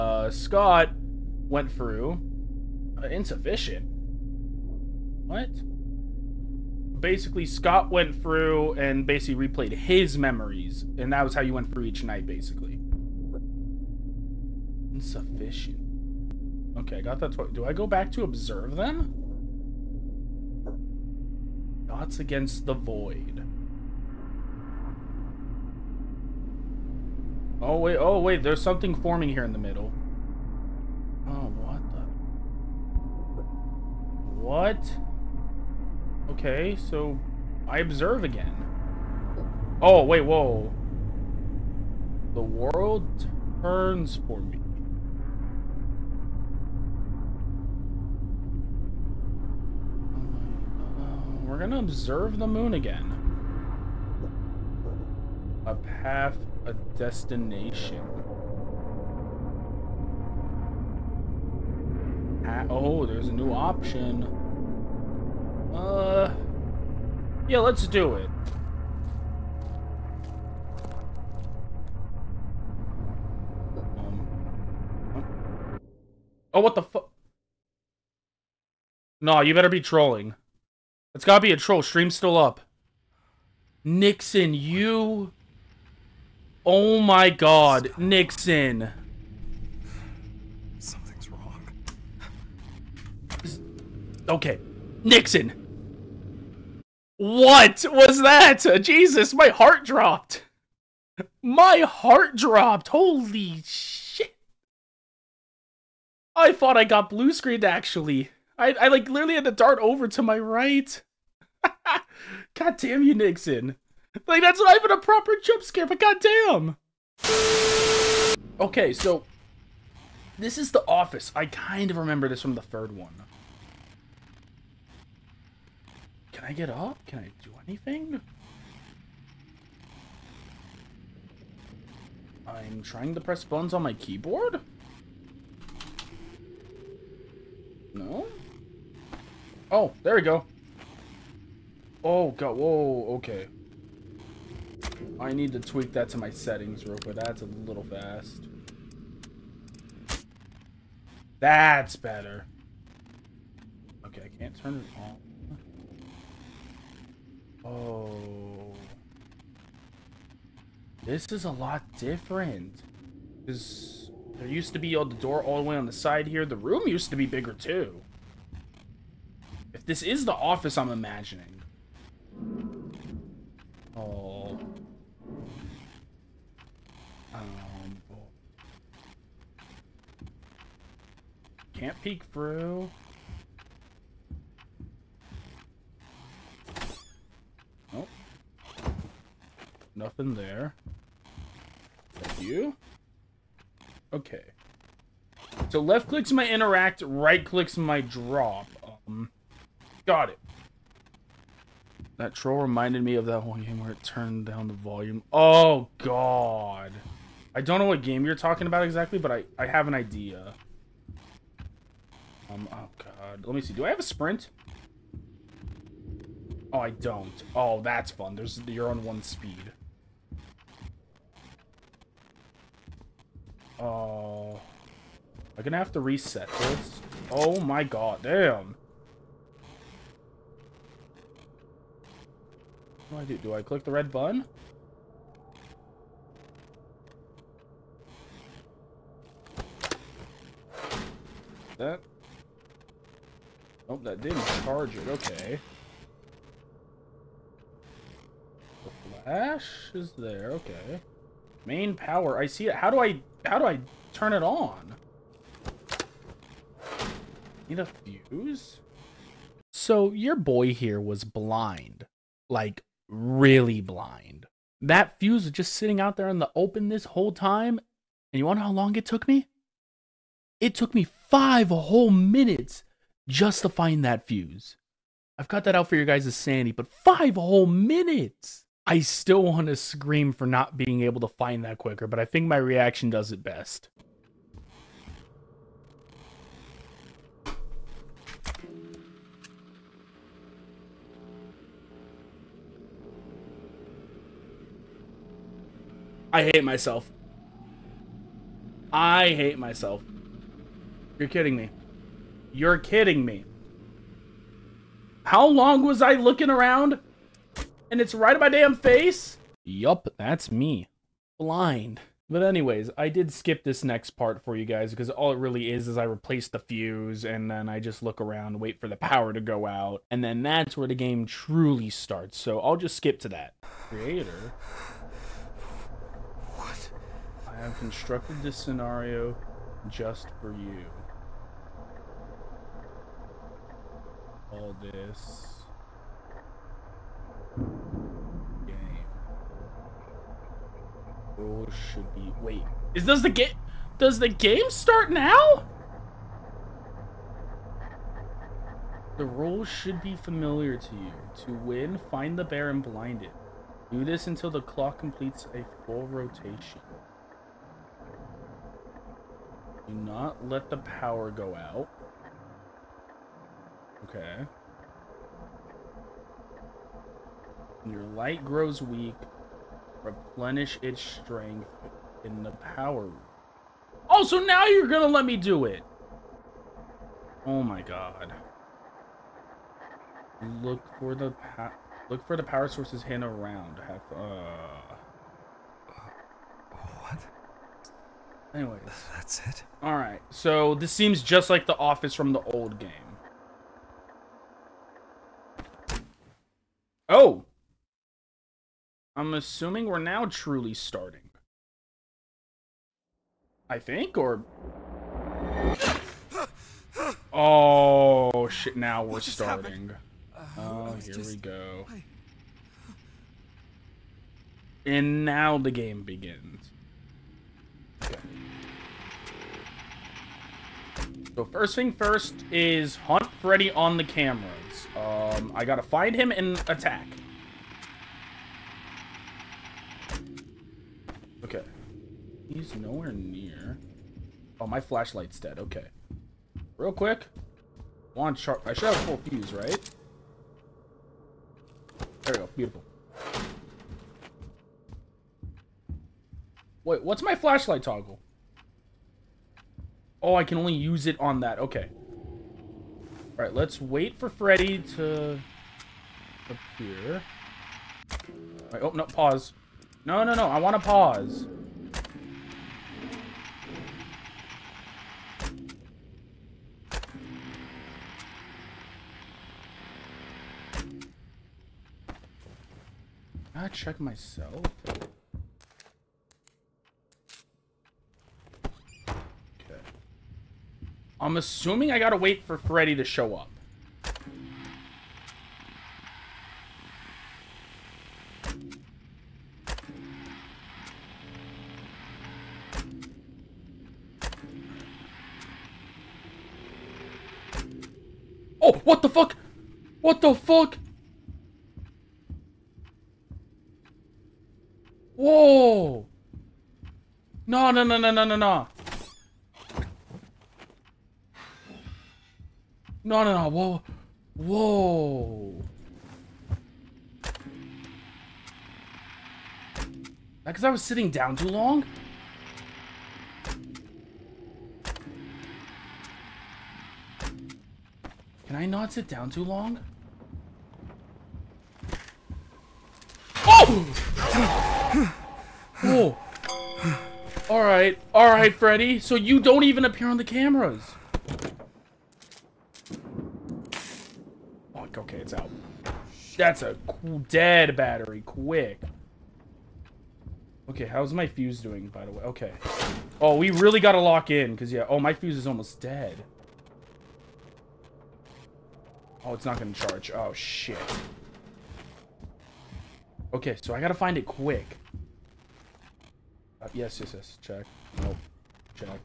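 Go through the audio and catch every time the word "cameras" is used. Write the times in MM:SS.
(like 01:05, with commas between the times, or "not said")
07:04, 09:00.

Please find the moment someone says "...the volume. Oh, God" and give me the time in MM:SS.
03:24.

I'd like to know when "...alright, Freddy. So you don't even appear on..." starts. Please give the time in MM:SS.
08:58.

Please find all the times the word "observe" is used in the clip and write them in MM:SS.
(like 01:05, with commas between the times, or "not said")
00:18, 00:37, 00:51.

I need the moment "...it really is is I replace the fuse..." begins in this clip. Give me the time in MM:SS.
05:15.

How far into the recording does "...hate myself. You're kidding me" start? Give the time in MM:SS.
04:59.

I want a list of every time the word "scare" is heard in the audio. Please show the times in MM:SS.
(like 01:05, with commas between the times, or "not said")
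01:55.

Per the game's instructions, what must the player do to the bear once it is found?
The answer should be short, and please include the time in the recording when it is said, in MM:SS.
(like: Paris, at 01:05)
Blind it, at 05:52.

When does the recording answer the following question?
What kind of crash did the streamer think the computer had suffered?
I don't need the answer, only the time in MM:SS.
01:47.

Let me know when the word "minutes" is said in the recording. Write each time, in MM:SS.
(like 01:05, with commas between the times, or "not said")
04:32, 04:37.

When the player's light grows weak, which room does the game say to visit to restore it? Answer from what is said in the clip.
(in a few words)
The power room.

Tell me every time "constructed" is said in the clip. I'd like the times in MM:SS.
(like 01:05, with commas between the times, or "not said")
05:27.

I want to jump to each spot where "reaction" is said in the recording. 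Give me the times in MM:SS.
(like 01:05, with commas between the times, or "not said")
04:42.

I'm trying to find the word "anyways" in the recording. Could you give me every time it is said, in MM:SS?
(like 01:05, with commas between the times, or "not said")
05:12, 06:28.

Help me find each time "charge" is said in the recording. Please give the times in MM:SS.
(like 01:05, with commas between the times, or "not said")
04:04, 09:19.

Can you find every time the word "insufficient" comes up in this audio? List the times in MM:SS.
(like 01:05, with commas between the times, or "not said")
00:03, 00:14.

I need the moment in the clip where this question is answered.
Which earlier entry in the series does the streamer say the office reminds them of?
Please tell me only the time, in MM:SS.
02:02.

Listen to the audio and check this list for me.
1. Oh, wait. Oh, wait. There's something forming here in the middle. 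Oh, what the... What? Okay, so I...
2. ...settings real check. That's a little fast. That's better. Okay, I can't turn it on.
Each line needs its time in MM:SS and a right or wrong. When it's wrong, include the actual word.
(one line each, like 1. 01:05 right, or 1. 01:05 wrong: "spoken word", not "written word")
1. 00:27 right
2. 02:26 wrong: "quick", not "check".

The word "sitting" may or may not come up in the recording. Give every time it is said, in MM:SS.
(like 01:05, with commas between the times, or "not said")
04:25, 08:40.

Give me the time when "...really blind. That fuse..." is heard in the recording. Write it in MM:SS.
04:23.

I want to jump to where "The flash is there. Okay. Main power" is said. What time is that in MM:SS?
04:08.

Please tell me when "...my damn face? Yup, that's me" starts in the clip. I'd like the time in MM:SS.
05:08.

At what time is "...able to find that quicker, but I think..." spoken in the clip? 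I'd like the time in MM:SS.
04:41.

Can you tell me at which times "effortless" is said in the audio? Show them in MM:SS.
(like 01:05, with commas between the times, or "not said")
not said.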